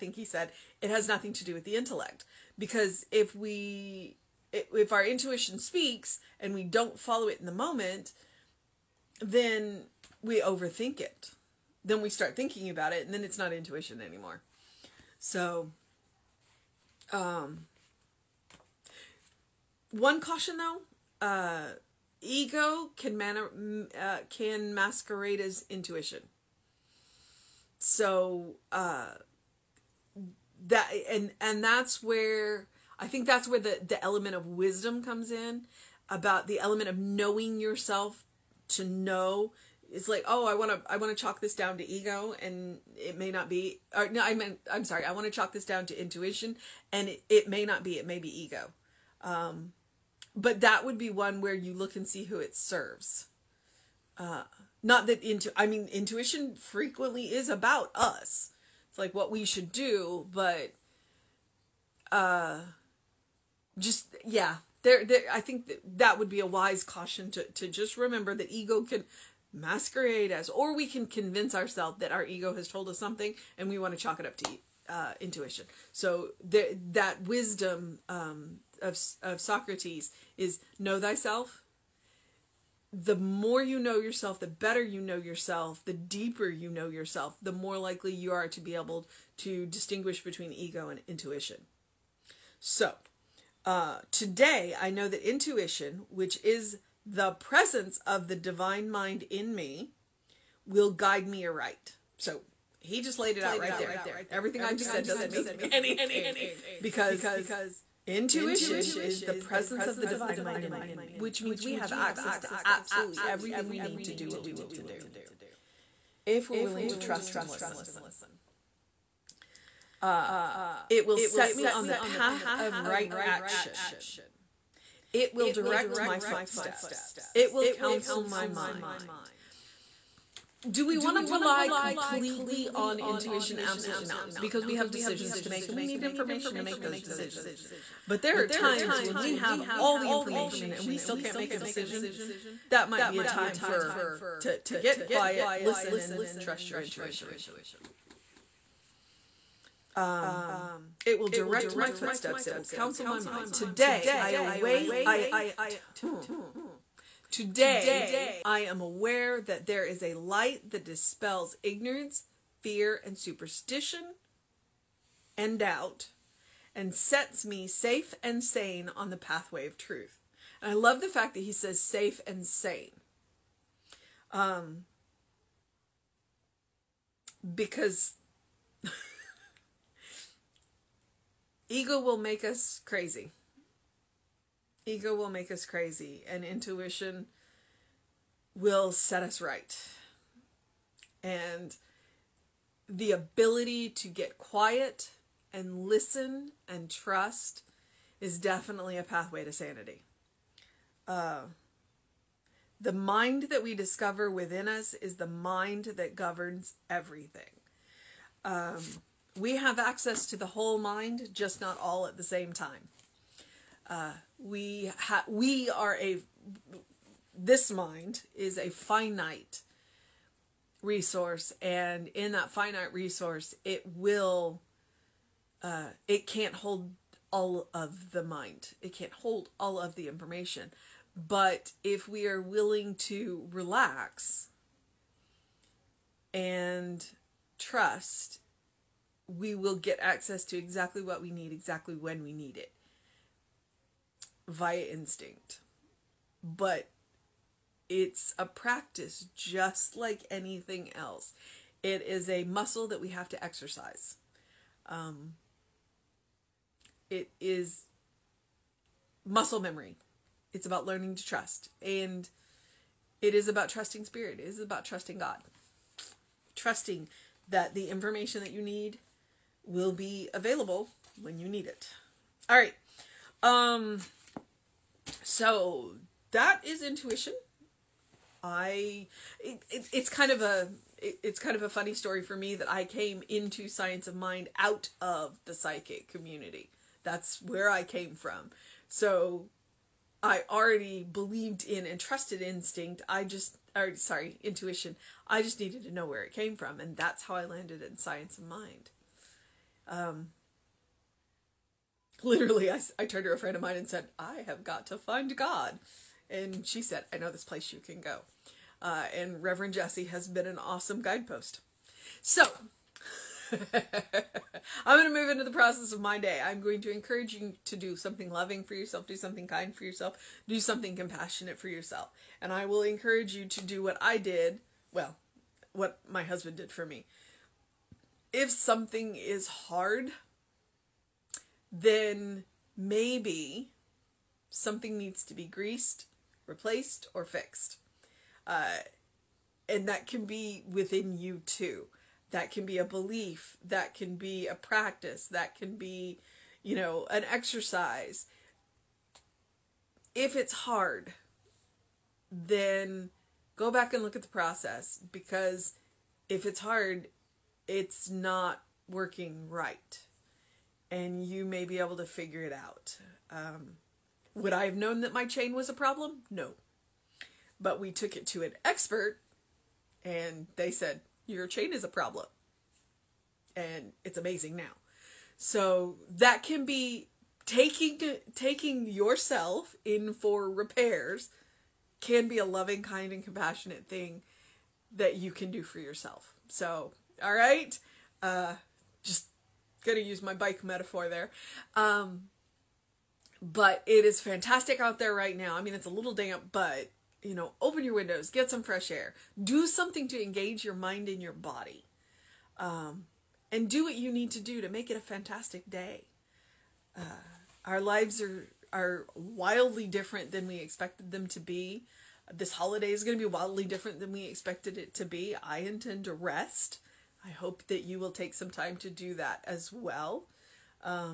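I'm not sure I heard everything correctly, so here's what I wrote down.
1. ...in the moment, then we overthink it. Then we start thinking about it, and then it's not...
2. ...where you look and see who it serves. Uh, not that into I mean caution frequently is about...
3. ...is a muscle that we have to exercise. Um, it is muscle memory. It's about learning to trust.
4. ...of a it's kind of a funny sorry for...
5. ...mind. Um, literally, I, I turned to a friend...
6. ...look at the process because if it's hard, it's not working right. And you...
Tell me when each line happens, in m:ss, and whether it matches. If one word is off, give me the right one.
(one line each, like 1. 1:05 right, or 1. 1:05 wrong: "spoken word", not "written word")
1. 0:07 right
2. 0:51 wrong: "intuition", not "caution"
3. 4:12 right
4. 4:40 wrong: "story", not "sorry"
5. 4:58 right
6. 5:54 right.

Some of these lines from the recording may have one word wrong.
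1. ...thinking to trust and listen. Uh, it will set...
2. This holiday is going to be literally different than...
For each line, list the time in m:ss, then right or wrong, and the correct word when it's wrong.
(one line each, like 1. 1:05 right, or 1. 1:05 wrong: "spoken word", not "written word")
1. 1:56 wrong: "willing", not "thinking"
2. 6:52 wrong: "wildly", not "literally".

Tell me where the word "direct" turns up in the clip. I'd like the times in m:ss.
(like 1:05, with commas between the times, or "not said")
2:05, 2:31.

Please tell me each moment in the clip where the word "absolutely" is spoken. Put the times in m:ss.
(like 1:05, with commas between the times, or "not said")
1:52, 2:13.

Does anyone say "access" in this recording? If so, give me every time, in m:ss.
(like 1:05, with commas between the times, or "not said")
1:51, 3:29, 4:00.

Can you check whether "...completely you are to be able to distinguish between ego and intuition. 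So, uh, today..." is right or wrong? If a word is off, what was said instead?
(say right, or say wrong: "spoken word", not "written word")
wrong: "likely", not "completely".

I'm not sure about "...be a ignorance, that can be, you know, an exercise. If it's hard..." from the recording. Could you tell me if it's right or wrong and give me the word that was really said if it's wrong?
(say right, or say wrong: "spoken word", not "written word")
wrong: "practice", not "ignorance".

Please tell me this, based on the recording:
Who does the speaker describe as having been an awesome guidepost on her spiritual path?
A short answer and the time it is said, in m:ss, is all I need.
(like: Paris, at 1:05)
Reverend Jesse, at 5:09.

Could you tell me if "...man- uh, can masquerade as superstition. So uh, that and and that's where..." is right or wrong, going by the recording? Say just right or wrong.
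wrong.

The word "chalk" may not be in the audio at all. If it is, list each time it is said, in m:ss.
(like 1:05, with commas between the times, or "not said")
0:41, 0:45, 1:13.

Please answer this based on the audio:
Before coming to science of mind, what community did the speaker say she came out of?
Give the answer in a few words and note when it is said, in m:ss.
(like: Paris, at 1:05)
The psychic community, at 4:45.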